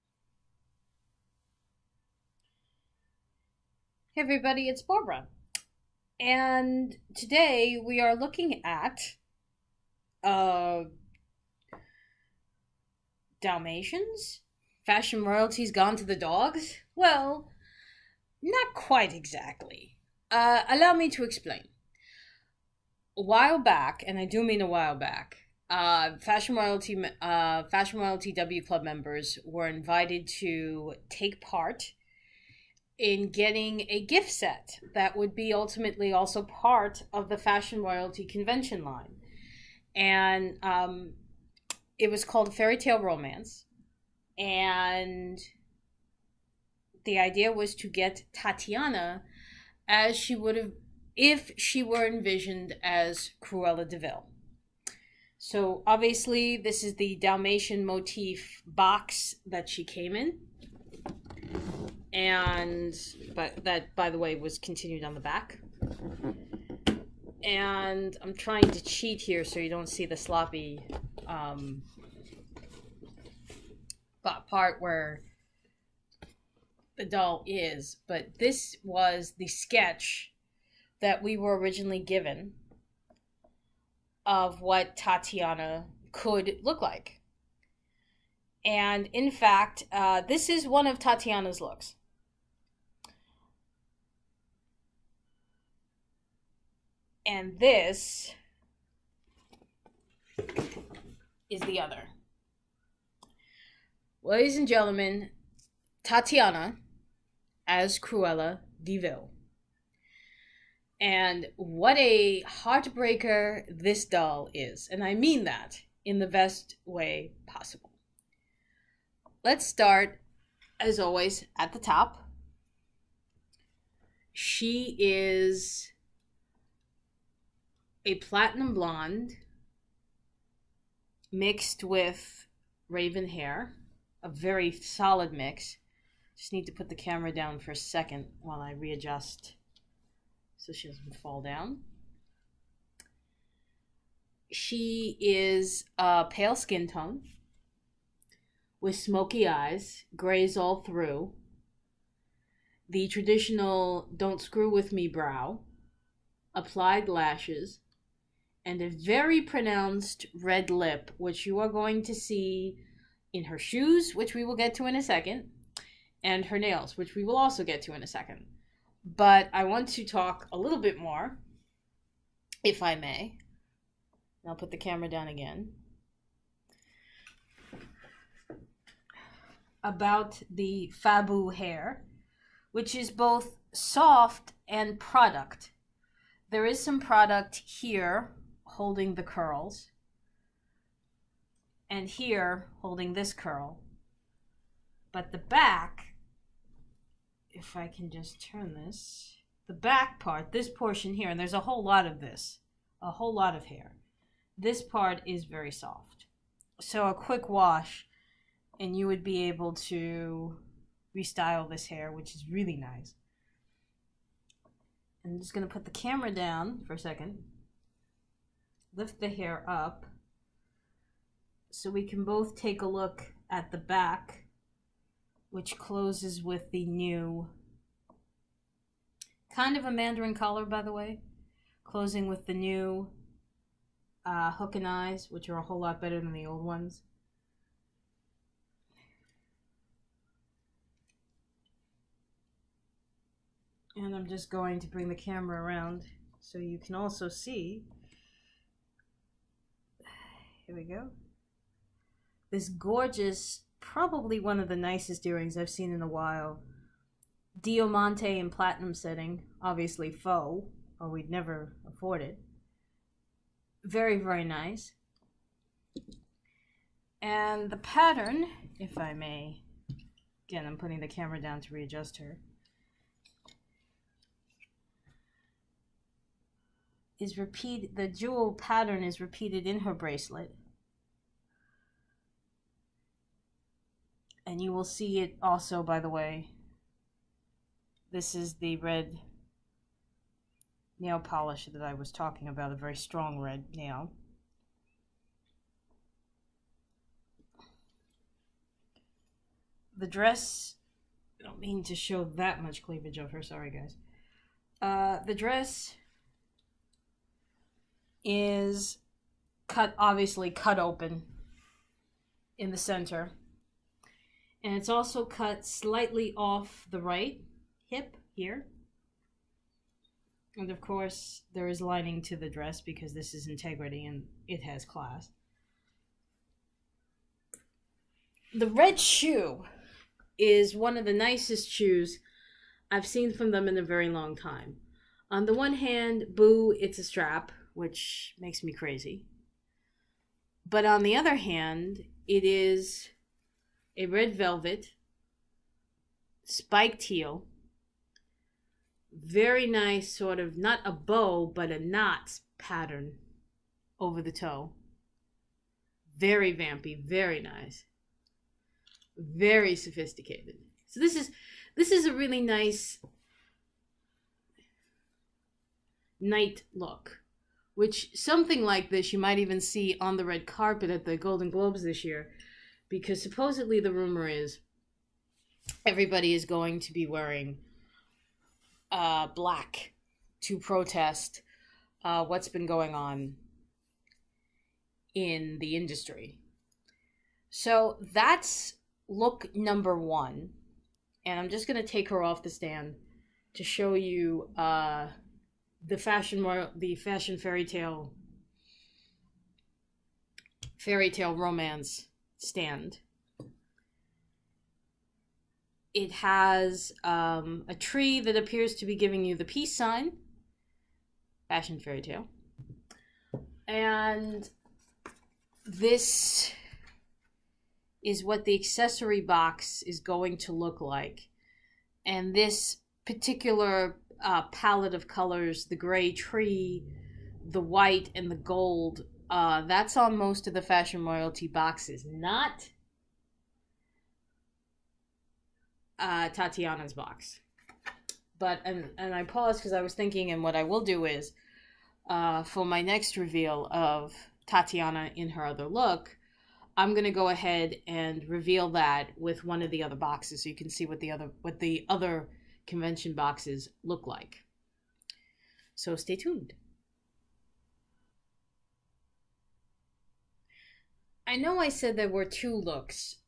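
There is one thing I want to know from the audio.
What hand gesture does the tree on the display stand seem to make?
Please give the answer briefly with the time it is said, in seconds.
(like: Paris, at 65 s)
Peace sign, at 409 s.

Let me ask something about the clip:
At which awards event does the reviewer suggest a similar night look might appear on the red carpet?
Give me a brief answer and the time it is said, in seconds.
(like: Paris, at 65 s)
Golden Globes, at 371 s.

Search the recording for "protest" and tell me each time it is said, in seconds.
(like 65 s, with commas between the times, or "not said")
380 s.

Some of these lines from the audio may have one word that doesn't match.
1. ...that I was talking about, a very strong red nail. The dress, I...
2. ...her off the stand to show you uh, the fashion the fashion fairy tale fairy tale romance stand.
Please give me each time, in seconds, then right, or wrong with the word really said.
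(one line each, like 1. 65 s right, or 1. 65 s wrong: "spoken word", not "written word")
1. 291 s right
2. 392 s right.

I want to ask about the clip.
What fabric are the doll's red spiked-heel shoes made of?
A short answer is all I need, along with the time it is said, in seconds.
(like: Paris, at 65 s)
Velvet, at 344 s.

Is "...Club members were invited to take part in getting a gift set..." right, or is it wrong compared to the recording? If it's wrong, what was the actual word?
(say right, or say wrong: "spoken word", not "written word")
right.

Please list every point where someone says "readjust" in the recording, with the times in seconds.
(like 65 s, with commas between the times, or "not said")
138 s, 271 s.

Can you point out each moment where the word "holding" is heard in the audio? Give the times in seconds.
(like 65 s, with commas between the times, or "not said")
188 s, 192 s.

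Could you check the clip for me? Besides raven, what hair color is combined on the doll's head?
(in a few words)
Platinum blonde.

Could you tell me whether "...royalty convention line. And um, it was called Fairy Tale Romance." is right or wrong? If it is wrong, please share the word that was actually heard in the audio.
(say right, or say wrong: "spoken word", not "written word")
right.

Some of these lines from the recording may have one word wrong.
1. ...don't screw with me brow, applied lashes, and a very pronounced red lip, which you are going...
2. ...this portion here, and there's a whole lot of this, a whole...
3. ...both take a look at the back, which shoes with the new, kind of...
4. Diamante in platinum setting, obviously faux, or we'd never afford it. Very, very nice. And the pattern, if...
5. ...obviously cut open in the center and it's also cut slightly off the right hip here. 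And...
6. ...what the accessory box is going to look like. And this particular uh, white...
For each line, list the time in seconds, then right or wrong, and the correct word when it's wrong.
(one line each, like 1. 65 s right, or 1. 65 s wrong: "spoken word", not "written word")
1. 154 s right
2. 200 s right
3. 222 s wrong: "closes", not "shoes"
4. 257 s right
5. 309 s right
6. 418 s wrong: "palette", not "white".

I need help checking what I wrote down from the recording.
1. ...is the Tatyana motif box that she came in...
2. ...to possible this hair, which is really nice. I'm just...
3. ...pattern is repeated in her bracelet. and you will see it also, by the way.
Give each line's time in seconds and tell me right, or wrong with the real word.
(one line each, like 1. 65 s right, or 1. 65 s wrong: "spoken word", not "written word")
1. 56 s wrong: "Dalmatian", not "Tatyana"
2. 209 s wrong: "restyle", not "possible"
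3. 278 s right.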